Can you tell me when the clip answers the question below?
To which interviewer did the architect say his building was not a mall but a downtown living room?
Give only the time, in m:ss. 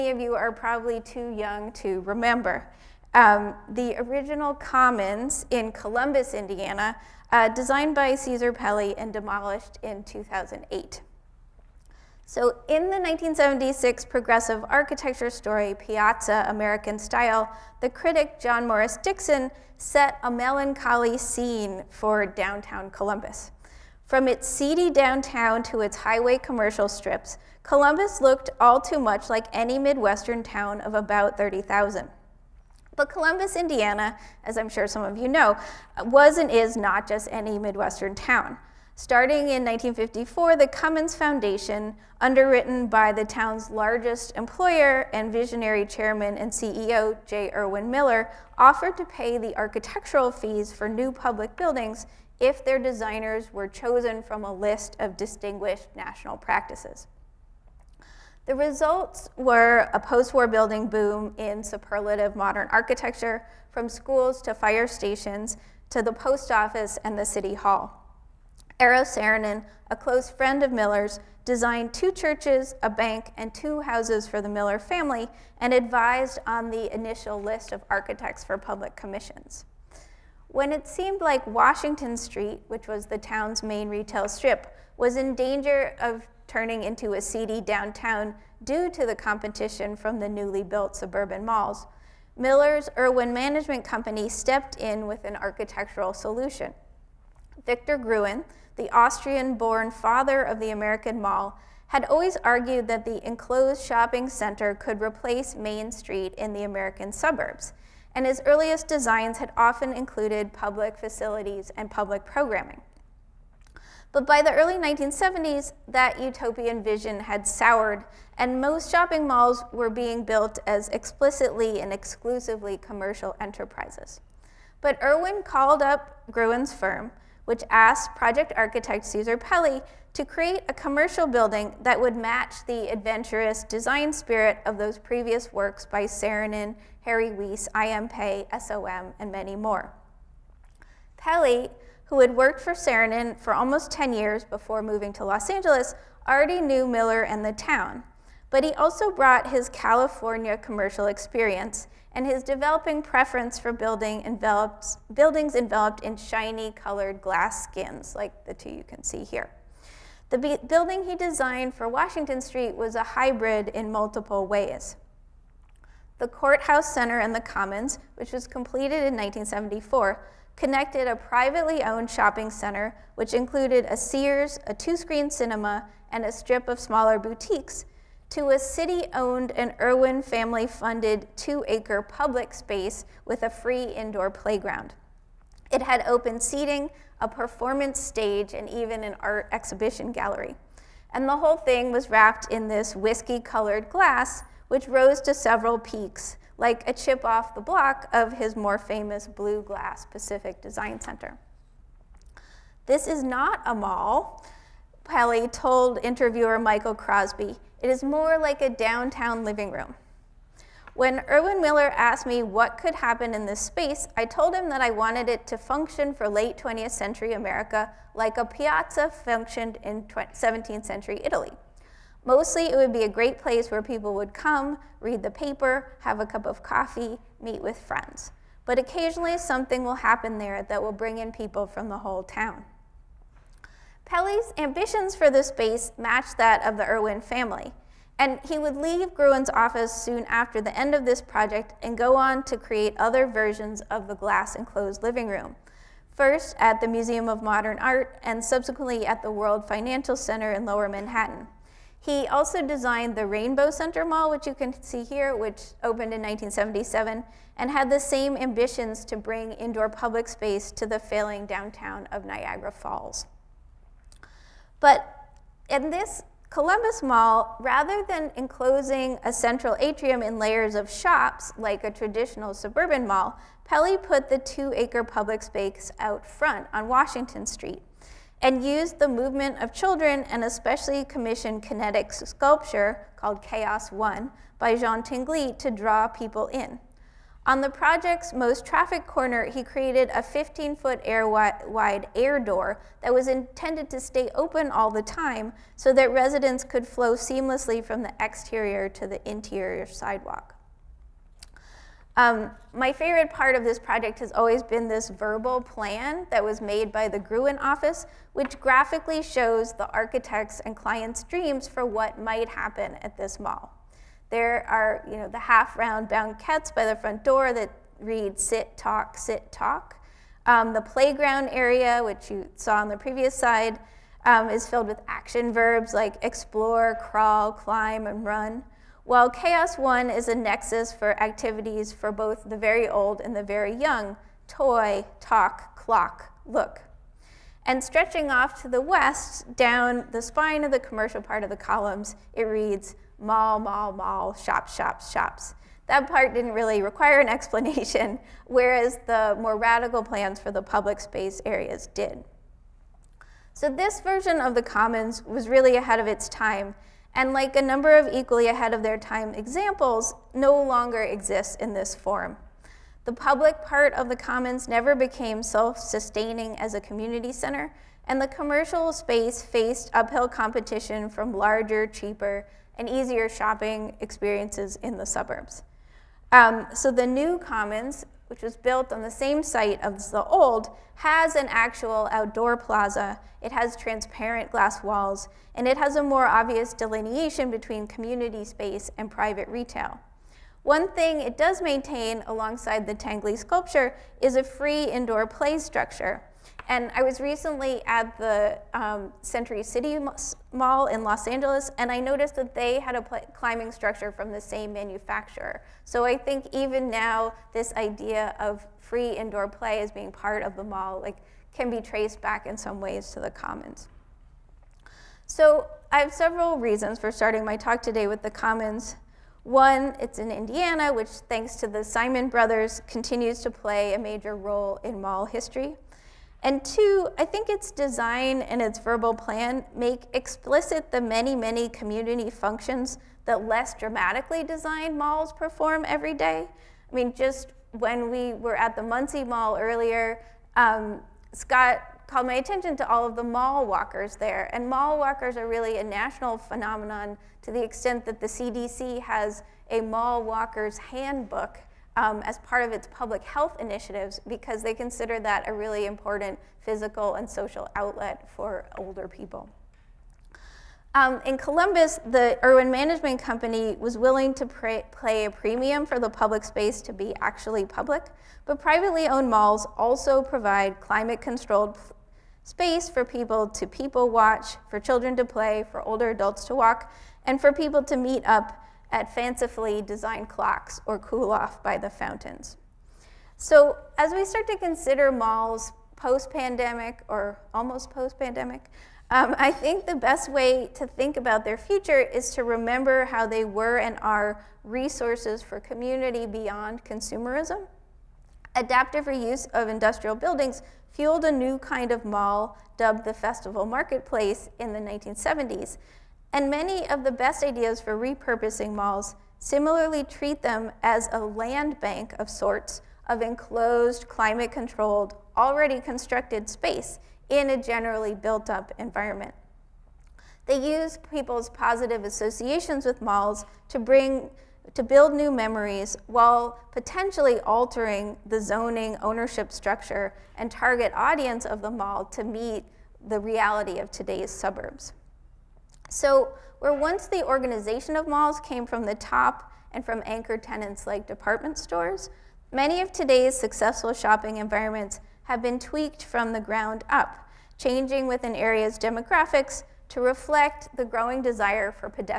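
3:26.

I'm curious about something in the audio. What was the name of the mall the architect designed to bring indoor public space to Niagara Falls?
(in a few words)
Rainbow Center Mall.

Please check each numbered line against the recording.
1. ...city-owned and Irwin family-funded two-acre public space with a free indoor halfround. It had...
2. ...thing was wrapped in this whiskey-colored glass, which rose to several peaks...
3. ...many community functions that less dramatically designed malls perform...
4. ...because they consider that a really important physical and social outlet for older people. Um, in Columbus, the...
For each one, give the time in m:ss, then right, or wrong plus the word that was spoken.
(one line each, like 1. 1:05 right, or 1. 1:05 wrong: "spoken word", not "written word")
1. 2:58 wrong: "playground", not "halfround"
2. 3:11 right
3. 7:11 right
4. 7:34 right.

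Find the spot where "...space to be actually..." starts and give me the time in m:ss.
7:46.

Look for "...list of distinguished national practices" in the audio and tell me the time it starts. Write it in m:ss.
0:54.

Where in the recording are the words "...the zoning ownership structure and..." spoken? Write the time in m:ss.
8:48.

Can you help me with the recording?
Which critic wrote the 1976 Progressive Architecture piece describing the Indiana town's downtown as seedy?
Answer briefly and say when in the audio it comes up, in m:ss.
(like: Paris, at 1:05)
John Morris Dixon, at 0:18.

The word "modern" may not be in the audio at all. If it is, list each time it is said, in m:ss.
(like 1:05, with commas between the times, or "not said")
1:02, 4:07.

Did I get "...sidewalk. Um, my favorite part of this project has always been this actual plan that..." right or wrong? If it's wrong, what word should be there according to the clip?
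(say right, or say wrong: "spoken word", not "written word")
wrong: "verbal", not "actual".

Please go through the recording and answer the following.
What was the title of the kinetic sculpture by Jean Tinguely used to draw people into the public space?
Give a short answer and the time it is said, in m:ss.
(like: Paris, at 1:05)
Chaos One, at 4:43.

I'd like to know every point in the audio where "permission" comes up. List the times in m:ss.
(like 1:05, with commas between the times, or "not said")
not said.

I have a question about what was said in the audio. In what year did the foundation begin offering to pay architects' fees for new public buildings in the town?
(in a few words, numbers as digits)
1954.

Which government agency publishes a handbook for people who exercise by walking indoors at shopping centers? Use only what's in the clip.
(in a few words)
CDC.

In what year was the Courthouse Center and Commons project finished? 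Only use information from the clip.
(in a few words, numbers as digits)
1974.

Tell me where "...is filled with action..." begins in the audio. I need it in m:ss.
5:24.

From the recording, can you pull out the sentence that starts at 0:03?
Um, the original commons in Columbus, Indiana, uh, designed by Cesar Pelli and demolished in 2008.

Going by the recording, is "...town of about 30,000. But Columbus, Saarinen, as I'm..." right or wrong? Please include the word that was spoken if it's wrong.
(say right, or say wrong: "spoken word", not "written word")
wrong: "Indiana", not "Saarinen".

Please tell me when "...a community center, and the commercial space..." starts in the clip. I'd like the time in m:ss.
6:06.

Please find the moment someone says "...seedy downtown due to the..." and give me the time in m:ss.
1:27.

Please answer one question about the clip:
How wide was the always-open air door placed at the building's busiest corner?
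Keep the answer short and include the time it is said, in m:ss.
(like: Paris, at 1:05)
15 feet, at 4:50.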